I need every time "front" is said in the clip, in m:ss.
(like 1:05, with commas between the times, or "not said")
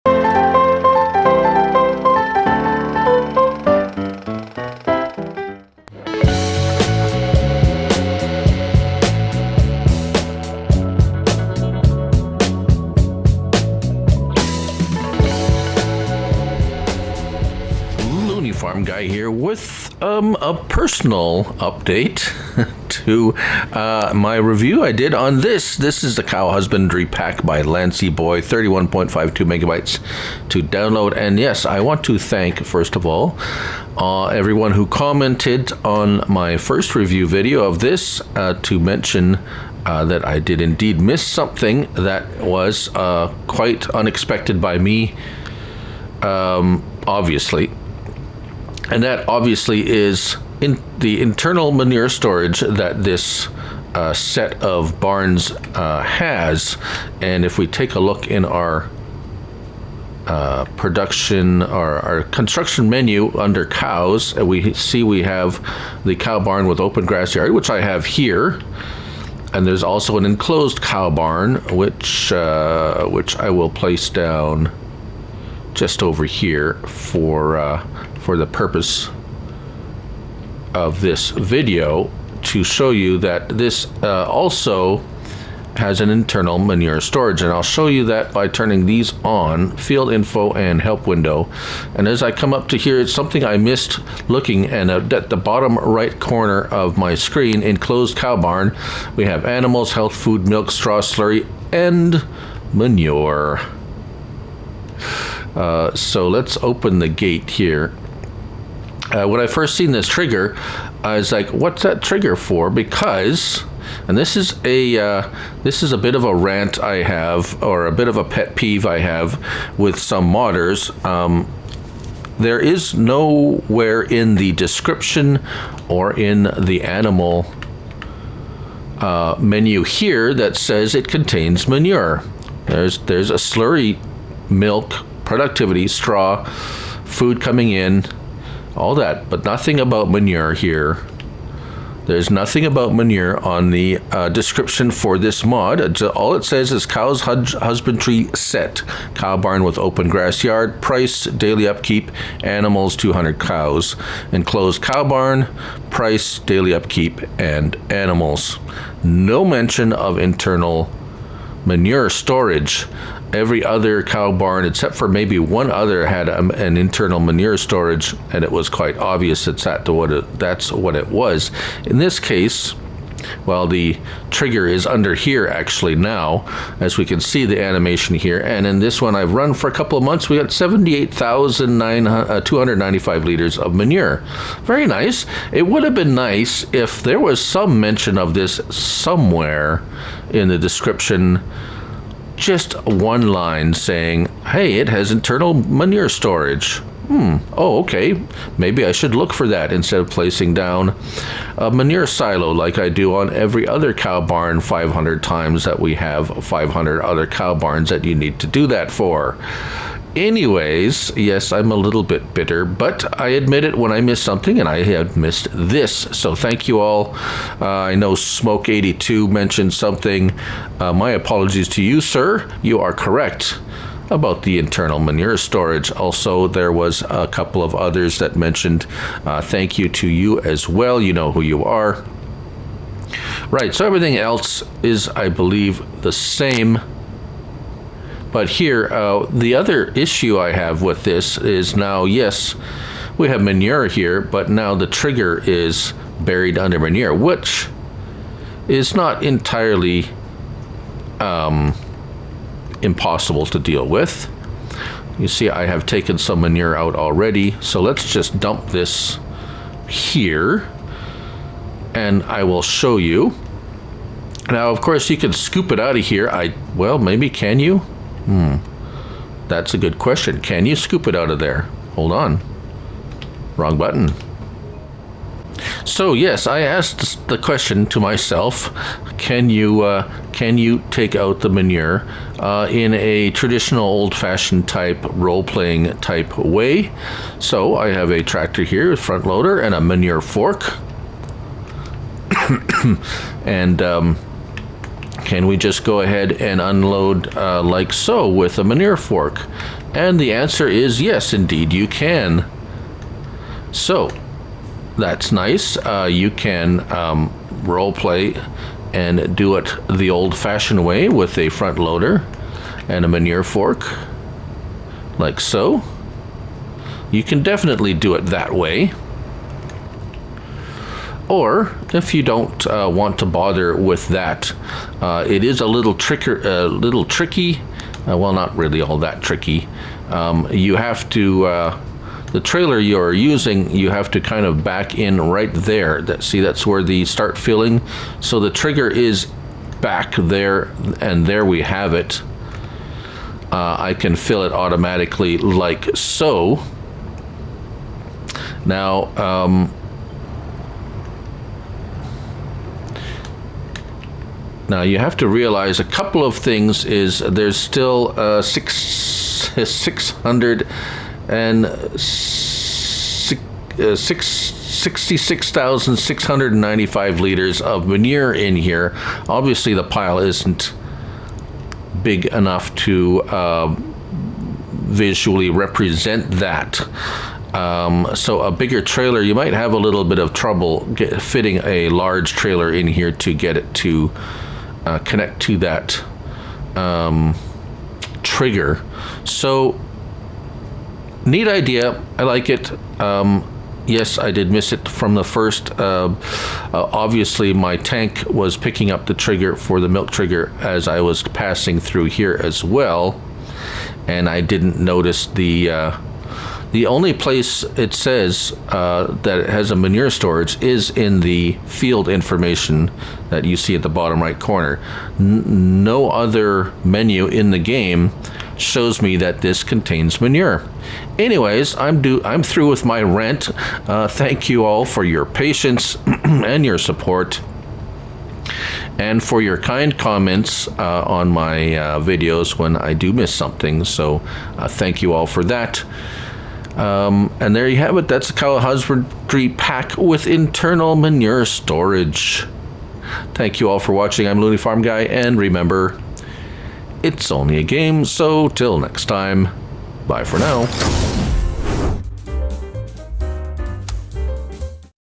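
4:48, 5:11.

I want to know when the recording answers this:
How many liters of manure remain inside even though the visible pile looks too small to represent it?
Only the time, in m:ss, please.
6:04.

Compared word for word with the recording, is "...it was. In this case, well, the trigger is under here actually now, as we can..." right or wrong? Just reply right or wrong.
right.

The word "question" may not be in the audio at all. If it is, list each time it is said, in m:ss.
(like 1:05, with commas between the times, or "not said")
4:29, 4:37.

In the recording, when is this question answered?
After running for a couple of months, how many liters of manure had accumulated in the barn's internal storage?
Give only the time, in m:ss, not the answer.
3:00.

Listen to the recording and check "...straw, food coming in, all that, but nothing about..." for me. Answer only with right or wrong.
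right.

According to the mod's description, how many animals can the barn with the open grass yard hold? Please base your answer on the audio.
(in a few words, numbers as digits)
200 cows.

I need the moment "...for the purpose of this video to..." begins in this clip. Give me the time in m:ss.
1:18.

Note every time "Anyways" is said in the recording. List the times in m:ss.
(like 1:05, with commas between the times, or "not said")
3:30, 7:01.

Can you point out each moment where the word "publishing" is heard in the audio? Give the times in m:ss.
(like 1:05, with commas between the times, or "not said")
not said.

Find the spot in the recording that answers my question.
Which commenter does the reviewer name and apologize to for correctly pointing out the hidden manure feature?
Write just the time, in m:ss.
3:38.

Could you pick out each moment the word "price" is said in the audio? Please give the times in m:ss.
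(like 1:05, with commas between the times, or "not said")
2:30, 2:35.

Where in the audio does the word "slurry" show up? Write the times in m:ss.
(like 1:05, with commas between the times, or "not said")
1:40, 2:13.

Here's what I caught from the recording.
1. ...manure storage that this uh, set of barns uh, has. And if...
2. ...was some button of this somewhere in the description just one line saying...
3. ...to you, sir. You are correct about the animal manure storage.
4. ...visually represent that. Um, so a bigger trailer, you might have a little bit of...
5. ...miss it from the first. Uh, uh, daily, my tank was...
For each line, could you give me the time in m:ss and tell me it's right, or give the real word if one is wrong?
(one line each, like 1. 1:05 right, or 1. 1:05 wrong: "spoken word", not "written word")
1. 0:51 right
2. 3:07 wrong: "mention", not "button"
3. 3:41 wrong: "internal", not "animal"
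4. 6:14 right
5. 6:34 wrong: "obviously", not "daily".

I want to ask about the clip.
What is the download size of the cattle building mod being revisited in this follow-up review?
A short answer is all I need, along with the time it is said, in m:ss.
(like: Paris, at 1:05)
31.52 megabytes, at 0:28.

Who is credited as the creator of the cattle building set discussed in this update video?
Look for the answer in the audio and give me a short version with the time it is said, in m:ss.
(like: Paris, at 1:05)
Lancyboi, at 0:27.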